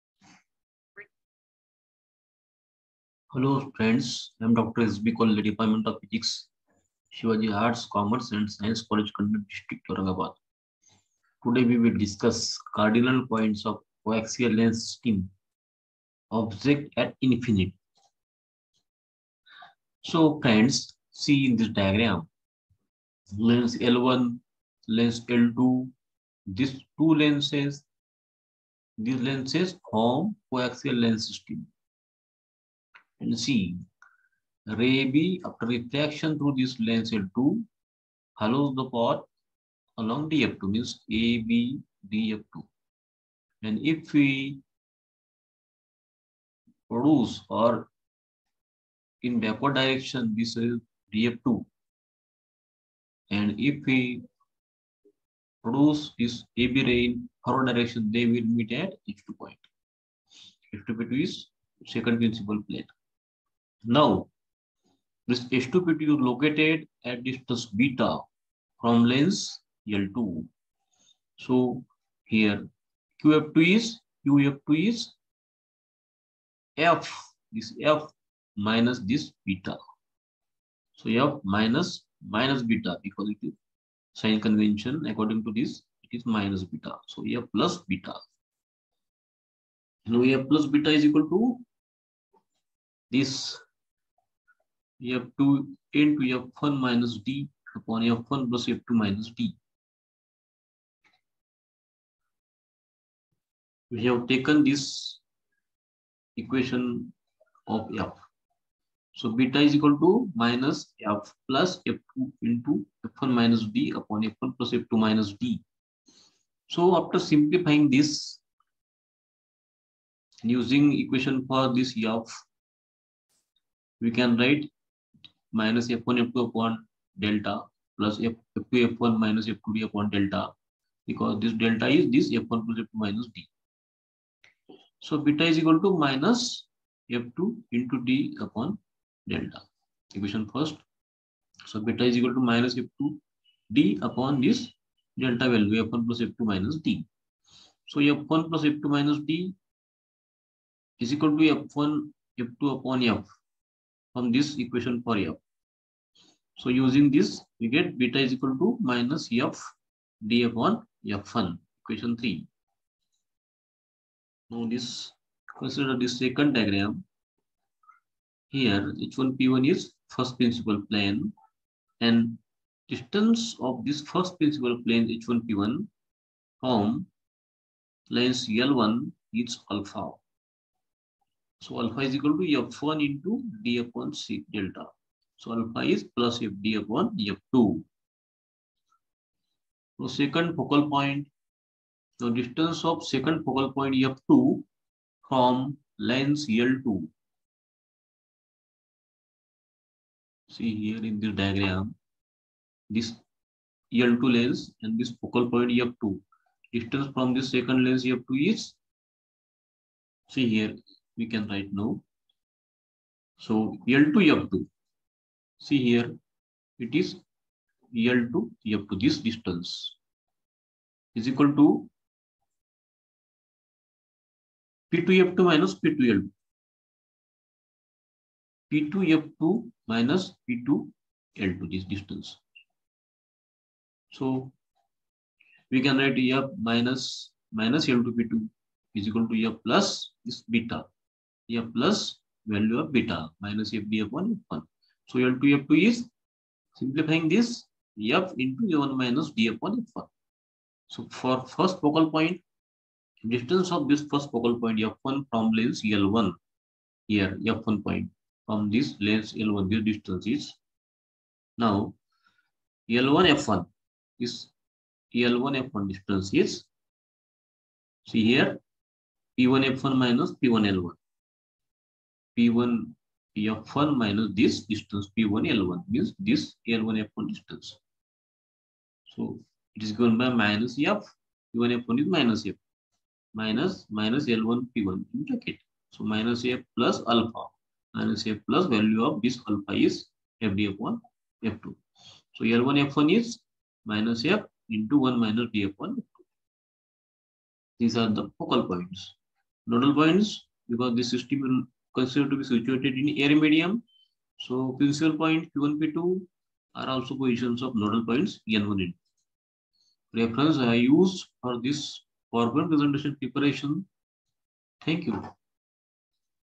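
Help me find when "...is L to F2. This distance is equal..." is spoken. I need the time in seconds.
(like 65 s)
216 s.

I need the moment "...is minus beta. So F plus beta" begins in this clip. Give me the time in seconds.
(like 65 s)
86 s.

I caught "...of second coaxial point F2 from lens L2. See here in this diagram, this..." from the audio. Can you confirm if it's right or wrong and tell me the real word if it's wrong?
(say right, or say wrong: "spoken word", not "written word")
wrong: "focal", not "coaxial".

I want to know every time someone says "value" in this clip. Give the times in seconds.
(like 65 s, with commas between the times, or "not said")
145 s, 242 s, 288 s.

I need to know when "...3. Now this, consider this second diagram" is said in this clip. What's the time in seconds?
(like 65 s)
162 s.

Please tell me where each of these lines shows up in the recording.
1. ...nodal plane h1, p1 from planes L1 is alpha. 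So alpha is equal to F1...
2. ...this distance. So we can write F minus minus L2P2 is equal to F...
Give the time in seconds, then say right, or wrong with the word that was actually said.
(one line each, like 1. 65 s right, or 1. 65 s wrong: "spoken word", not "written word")
1. 174 s wrong: "principal", not "nodal"
2. 231 s right.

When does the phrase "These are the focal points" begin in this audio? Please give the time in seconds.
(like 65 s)
297 s.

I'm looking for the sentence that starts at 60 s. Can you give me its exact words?
H2 point is second principal plane.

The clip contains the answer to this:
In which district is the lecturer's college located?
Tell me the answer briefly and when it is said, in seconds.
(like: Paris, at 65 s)
Aurangabad, at 9 s.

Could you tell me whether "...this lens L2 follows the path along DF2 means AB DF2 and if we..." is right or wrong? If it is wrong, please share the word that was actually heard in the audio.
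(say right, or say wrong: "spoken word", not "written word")
right.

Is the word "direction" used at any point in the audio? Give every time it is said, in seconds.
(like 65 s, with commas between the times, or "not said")
49 s, 57 s.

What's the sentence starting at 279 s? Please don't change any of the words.
So it is given by minus F.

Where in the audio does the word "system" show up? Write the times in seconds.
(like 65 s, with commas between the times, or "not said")
14 s, 31 s, 301 s.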